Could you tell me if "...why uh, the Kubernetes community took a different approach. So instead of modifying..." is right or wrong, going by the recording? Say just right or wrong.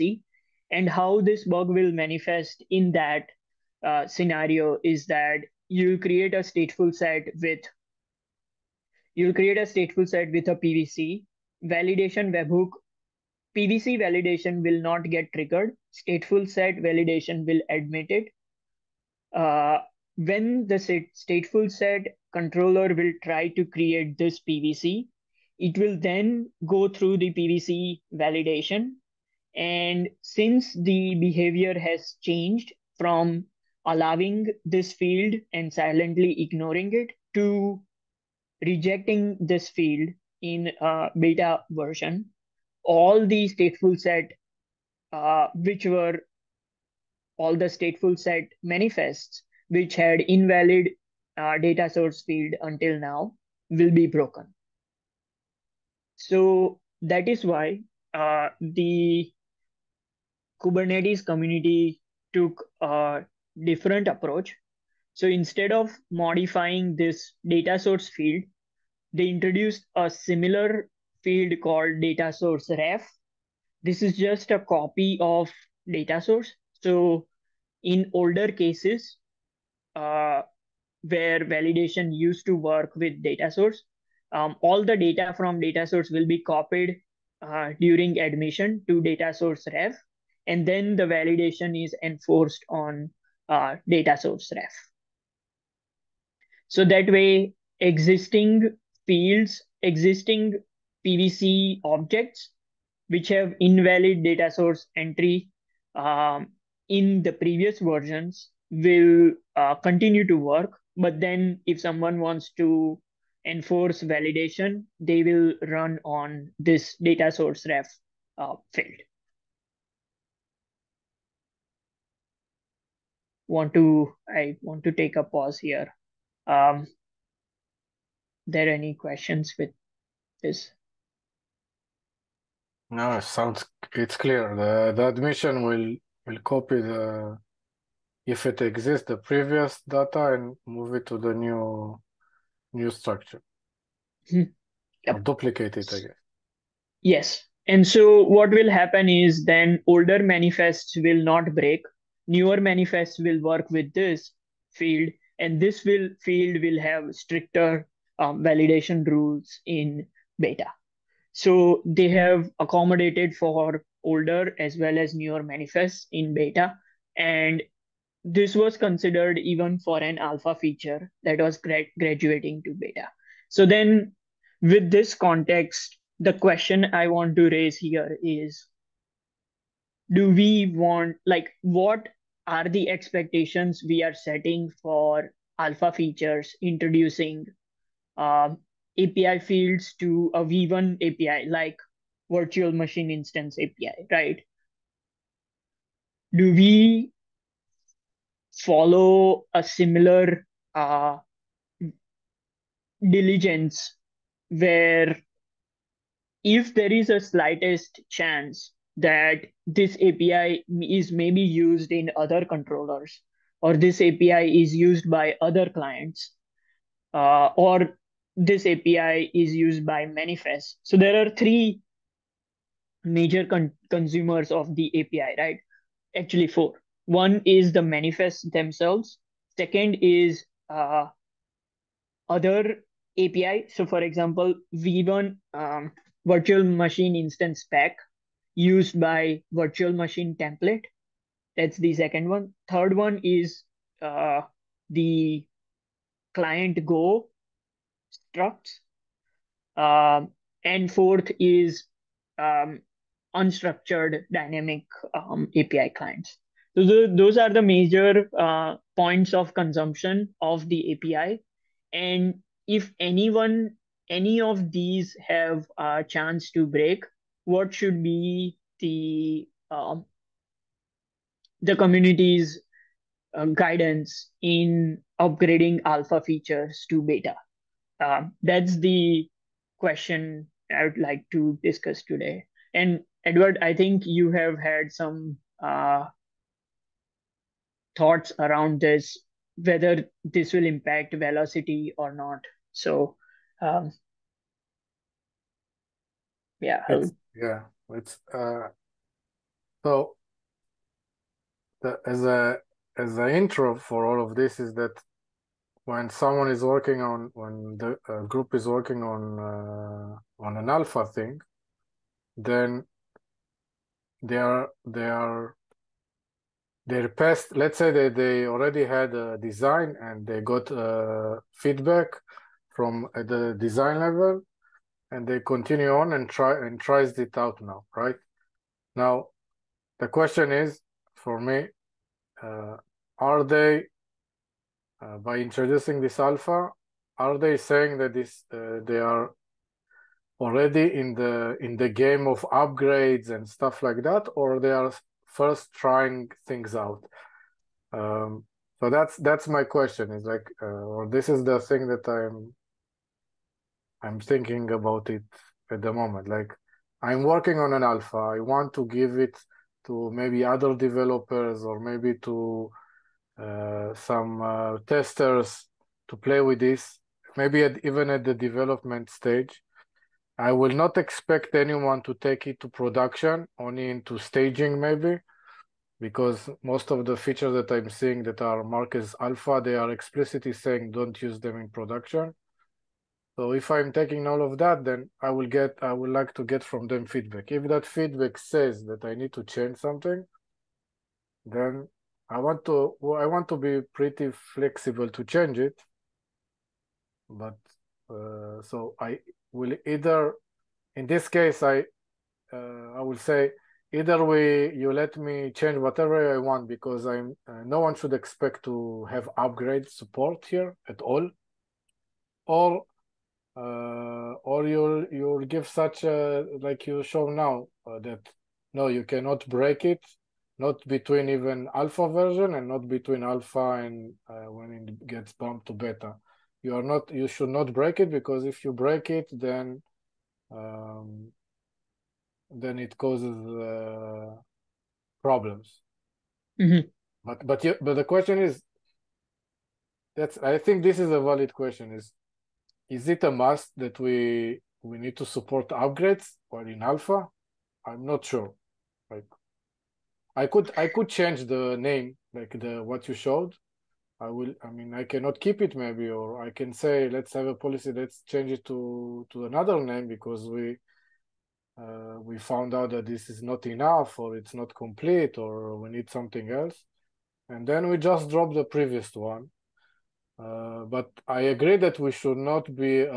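right.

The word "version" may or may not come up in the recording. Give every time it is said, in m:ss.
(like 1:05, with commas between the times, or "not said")
0:41, 1:47, 7:02.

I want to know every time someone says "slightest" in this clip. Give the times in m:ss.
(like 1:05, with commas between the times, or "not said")
3:27.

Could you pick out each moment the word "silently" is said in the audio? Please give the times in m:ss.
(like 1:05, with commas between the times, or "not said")
0:35.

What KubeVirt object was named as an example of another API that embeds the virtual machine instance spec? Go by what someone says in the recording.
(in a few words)
virtual machine template.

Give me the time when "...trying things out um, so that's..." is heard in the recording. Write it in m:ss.
5:45.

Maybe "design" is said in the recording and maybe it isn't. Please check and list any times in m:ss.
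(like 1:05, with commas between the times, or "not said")
5:19, 5:23.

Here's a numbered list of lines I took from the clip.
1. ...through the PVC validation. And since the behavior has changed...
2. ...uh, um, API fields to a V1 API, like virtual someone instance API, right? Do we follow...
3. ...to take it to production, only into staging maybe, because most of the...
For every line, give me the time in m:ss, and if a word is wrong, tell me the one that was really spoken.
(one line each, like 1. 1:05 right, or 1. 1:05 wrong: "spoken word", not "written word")
1. 0:26 right
2. 3:08 wrong: "machine", not "someone"
3. 6:12 right.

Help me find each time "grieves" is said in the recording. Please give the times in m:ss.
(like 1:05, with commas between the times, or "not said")
not said.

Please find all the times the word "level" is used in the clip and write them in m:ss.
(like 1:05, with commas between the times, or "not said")
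5:23.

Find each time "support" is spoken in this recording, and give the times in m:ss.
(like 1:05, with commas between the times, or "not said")
6:49, 7:25.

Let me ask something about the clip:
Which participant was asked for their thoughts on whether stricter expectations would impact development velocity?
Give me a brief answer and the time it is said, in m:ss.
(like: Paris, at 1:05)
Edward, at 4:43.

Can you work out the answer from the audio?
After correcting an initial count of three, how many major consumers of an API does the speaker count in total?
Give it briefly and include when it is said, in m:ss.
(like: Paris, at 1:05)
4, at 3:46.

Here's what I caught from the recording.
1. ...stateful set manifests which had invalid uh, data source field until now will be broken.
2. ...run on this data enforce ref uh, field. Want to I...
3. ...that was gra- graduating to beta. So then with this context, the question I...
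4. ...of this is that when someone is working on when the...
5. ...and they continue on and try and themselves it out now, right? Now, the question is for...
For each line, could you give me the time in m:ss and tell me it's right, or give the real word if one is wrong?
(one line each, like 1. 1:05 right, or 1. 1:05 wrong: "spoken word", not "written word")
1. 0:47 right
2. 1:55 wrong: "source", not "enforce"
3. 2:51 right
4. 5:04 right
5. 5:25 wrong: "tries", not "themselves".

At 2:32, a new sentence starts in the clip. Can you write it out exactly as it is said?
Newer manifests will work with this field, and this will field will have stricter um, validation rules in beta.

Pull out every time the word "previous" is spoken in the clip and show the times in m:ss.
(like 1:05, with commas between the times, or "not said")
1:47, 2:19, 7:48.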